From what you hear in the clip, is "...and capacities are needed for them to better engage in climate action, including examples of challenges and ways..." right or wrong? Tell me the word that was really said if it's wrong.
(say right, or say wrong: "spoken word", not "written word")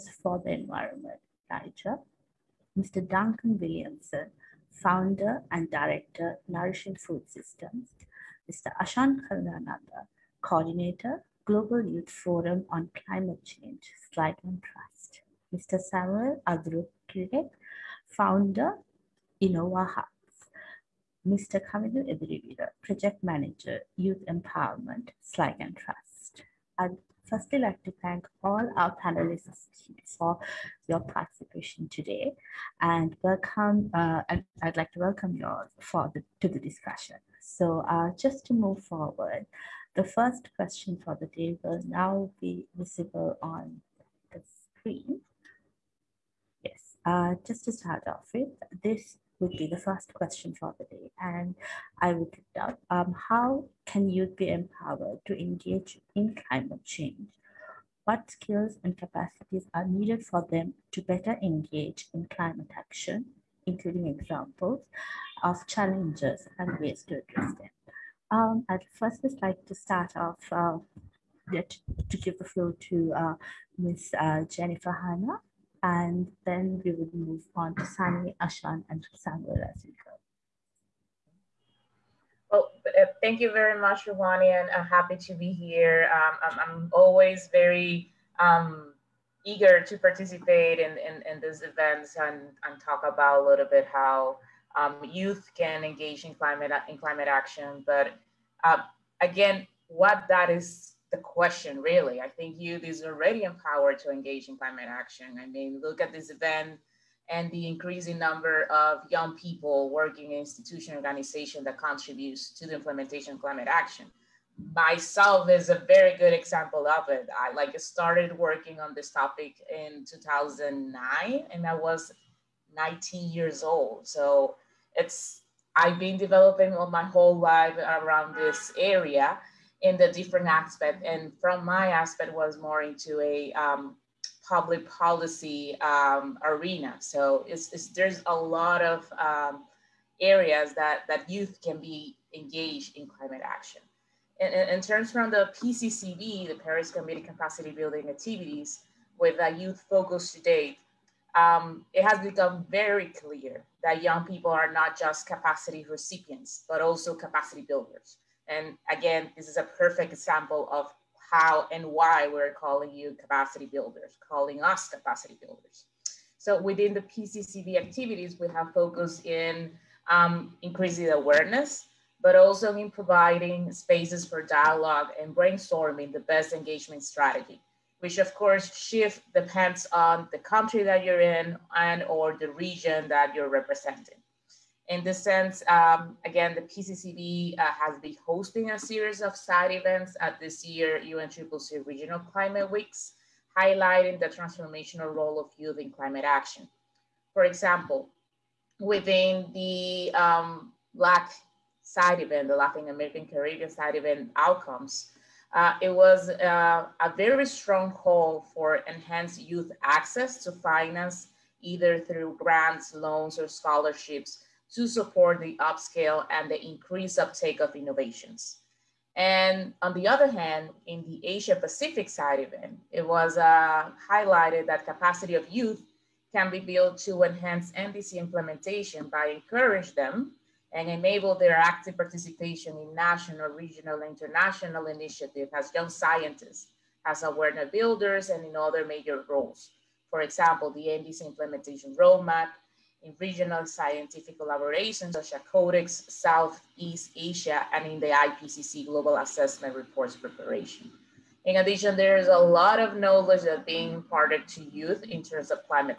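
right.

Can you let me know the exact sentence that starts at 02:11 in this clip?
And from my aspect was more into a um, public policy um, arena.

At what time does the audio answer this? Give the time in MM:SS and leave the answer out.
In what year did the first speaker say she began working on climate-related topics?
02:00.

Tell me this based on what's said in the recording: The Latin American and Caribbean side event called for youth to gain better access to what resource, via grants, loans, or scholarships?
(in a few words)
finance.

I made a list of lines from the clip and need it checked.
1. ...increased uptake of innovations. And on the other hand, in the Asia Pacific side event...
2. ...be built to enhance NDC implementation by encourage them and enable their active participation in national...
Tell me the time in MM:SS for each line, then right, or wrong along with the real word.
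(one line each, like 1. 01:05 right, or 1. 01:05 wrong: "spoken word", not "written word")
1. 03:36 right
2. 03:46 right.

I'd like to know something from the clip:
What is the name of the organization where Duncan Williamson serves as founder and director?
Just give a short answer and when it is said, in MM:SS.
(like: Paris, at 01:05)
Nourishing Food Systems, at 00:06.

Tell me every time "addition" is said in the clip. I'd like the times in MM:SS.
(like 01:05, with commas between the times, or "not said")
04:11.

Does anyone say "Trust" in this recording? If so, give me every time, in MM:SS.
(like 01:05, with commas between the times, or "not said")
00:14, 00:25.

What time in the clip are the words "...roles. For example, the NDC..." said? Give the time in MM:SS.
03:59.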